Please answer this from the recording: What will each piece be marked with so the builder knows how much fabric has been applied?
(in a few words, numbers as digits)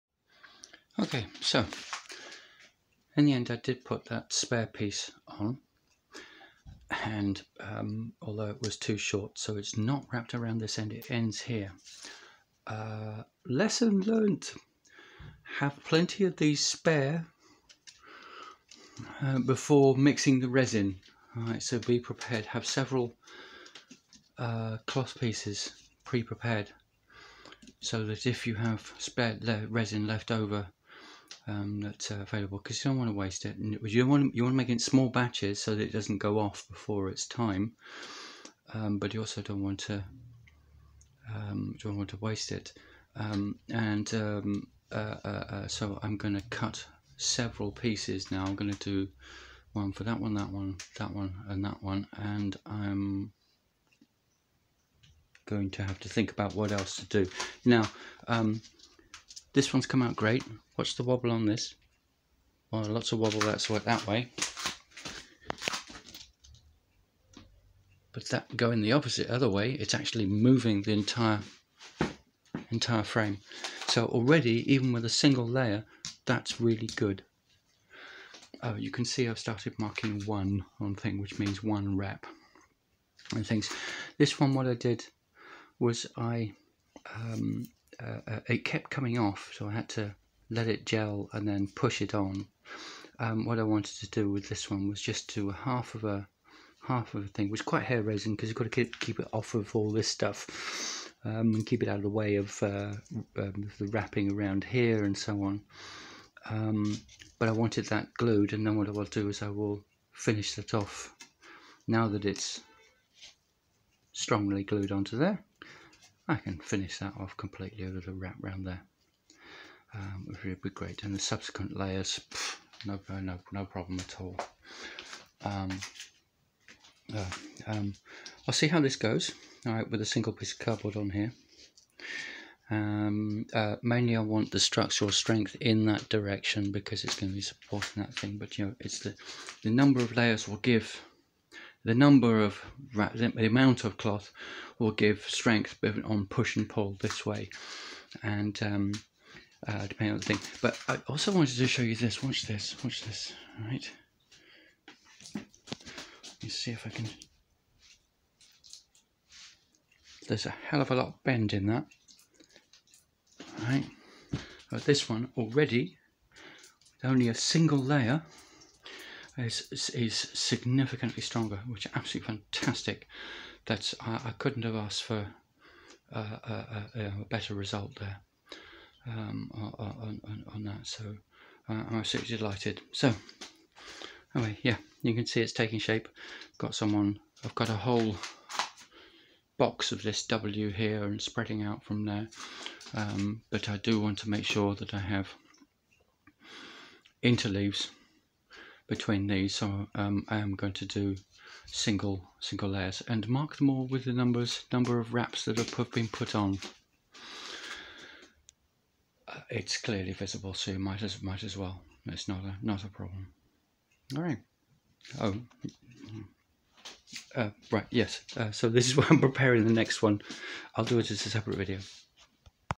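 number of wraps.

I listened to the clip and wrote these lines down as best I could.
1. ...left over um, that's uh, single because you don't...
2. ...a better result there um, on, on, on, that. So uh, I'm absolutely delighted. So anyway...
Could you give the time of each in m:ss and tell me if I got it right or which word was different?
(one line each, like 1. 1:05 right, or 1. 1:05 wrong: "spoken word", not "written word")
1. 0:30 wrong: "available", not "single"
2. 2:57 right.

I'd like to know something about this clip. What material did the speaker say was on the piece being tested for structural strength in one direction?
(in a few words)
cardboard.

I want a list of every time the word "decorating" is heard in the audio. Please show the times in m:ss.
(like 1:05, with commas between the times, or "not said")
not said.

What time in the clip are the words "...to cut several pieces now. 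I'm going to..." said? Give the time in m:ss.
0:46.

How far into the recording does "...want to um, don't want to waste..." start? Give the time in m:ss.
0:39.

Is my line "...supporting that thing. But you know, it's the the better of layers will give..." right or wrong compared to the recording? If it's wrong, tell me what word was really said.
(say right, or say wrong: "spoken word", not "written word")
wrong: "number", not "better".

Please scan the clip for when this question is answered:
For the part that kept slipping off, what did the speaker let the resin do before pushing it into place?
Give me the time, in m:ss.
1:30.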